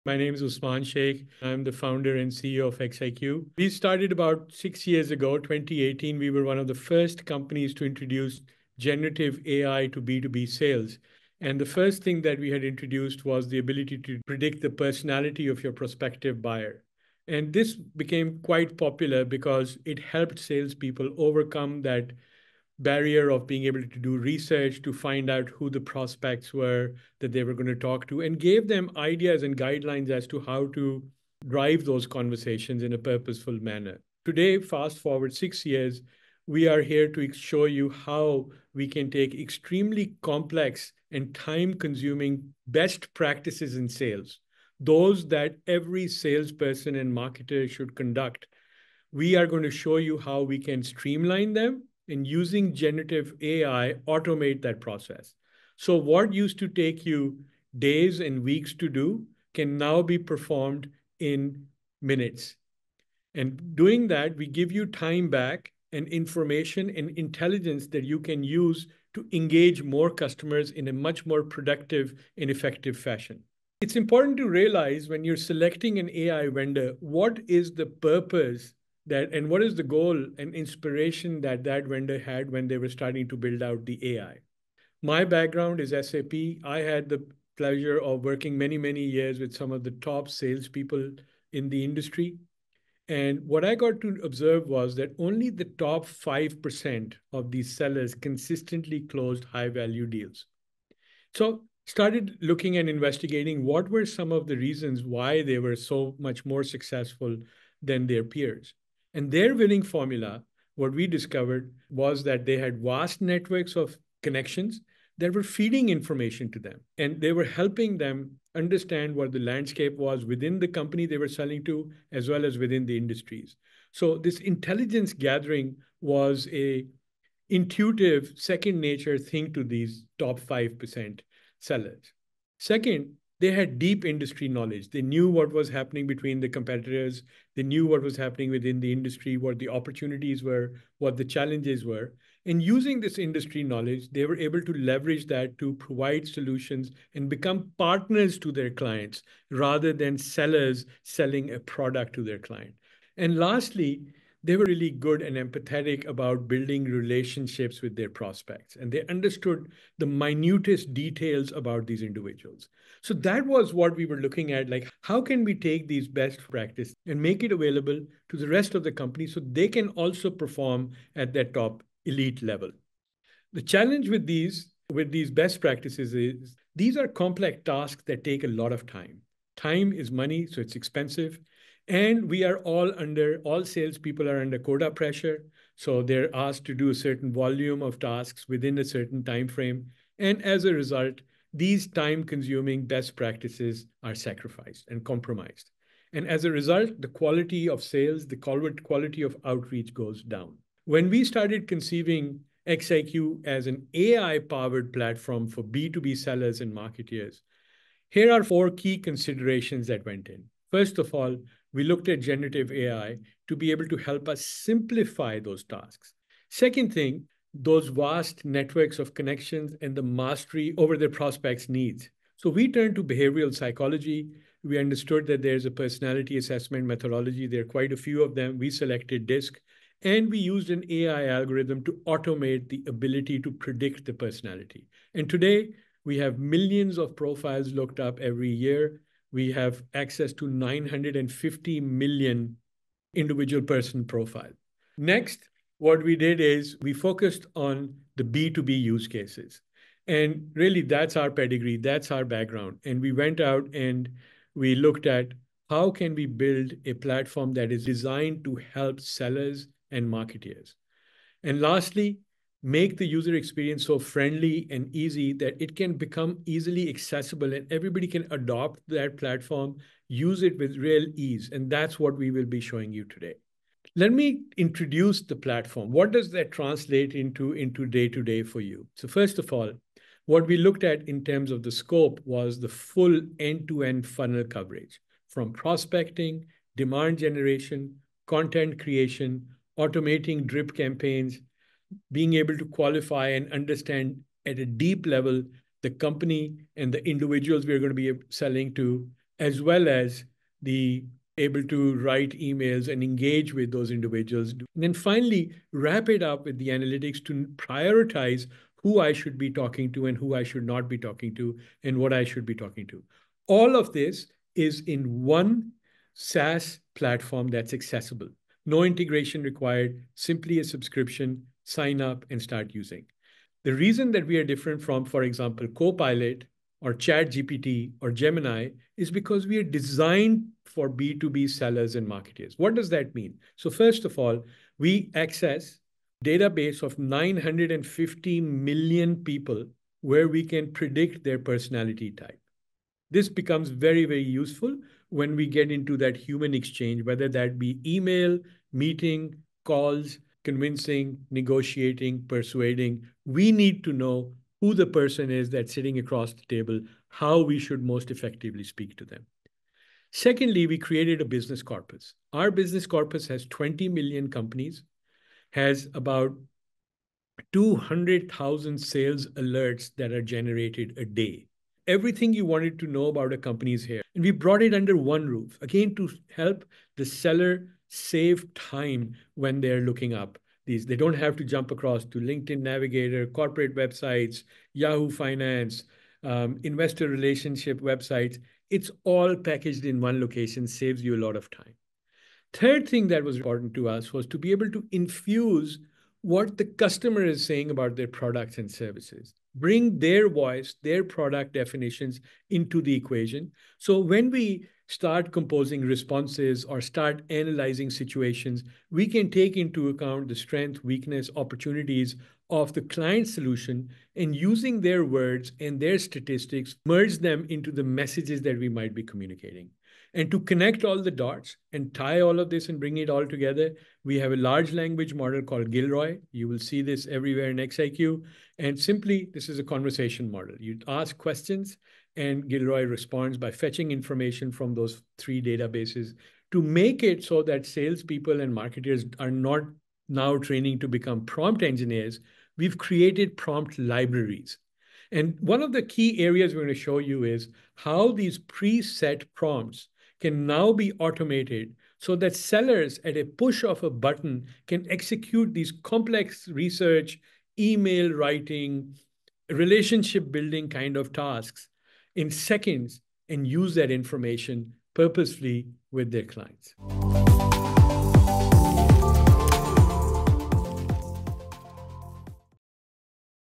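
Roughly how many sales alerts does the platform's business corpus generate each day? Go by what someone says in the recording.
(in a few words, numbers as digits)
200,000.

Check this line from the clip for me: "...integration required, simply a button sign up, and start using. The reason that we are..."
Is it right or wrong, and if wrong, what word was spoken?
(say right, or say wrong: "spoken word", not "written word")
wrong: "subscription", not "button".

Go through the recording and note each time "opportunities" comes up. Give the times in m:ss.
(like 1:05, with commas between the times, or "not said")
2:19, 6:51.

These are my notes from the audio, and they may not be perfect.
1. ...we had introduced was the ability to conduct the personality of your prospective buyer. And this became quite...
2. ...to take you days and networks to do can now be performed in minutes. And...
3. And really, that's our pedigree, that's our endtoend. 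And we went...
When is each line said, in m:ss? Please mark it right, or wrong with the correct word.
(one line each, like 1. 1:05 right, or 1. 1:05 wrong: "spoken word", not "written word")
1. 0:12 wrong: "predict", not "conduct"
2. 0:56 wrong: "weeks", not "networks"
3. 4:10 wrong: "background", not "endtoend".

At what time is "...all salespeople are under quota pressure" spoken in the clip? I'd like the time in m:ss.
3:03.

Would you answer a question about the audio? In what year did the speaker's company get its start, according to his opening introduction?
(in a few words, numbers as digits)
2018.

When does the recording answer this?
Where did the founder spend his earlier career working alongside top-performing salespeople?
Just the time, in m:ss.
1:25.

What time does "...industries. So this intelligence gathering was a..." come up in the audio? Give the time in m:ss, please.
2:02.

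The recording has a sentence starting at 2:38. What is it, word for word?
And they understood the minutest details about these individuals.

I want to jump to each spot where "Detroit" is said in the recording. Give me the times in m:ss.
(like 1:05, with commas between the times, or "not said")
not said.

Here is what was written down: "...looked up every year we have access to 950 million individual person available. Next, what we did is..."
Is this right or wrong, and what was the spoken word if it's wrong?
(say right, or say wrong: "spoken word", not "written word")
wrong: "profile", not "available".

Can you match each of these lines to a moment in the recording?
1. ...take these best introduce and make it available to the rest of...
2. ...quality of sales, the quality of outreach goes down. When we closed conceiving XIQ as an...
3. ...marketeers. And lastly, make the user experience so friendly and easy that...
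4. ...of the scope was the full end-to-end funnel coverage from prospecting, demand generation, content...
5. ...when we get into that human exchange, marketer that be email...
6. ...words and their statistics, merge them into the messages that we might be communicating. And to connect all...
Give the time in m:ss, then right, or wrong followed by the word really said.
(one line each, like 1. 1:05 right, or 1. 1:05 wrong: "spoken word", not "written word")
1. 2:45 wrong: "practice", not "introduce"
2. 3:17 wrong: "started", not "closed"
3. 4:20 right
4. 4:41 right
5. 5:45 wrong: "whether", not "marketer"
6. 6:55 right.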